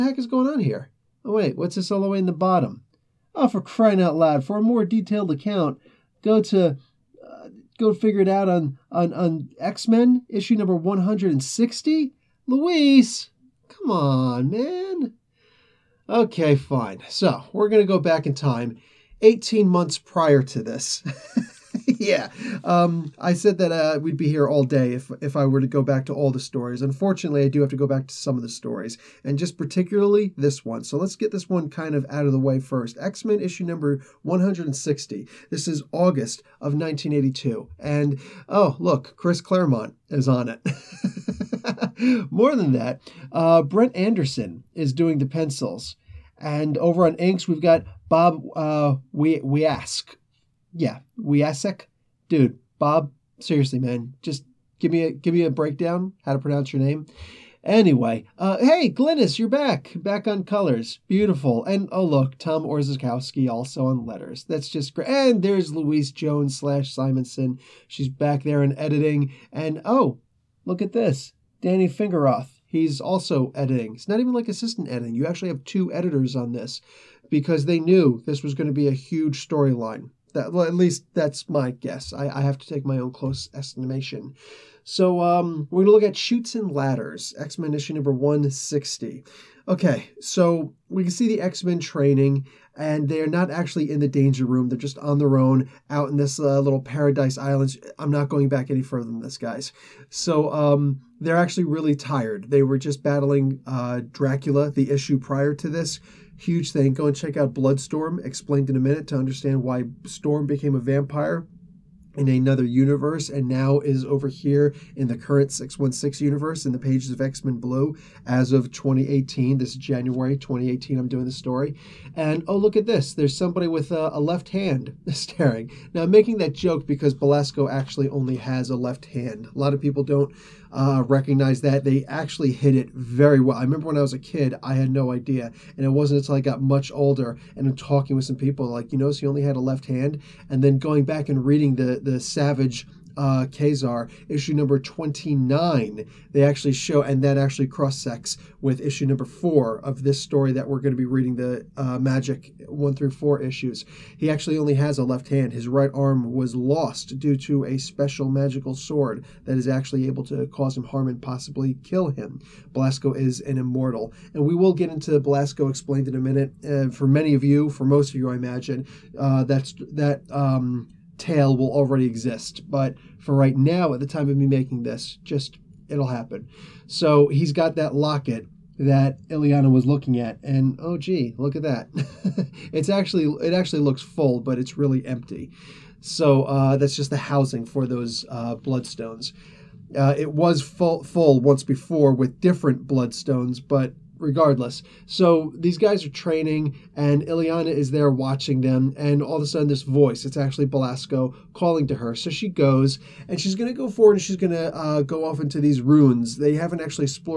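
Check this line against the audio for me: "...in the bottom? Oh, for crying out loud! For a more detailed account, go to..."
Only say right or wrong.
right.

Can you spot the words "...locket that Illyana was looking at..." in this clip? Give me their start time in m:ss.
2:57.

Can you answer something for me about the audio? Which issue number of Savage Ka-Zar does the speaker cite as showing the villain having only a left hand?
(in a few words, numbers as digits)
29.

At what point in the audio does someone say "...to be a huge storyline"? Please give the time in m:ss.
1:18.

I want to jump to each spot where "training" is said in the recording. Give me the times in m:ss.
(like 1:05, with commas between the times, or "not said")
1:31, 3:16.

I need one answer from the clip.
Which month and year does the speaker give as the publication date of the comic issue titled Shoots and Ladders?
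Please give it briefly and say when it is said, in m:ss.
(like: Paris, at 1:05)
August 1982, at 0:35.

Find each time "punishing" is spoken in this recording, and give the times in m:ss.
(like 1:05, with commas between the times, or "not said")
not said.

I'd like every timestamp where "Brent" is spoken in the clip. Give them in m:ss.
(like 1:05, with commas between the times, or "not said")
0:43.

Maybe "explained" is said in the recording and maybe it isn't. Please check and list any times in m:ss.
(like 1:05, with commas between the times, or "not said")
1:48, 2:45.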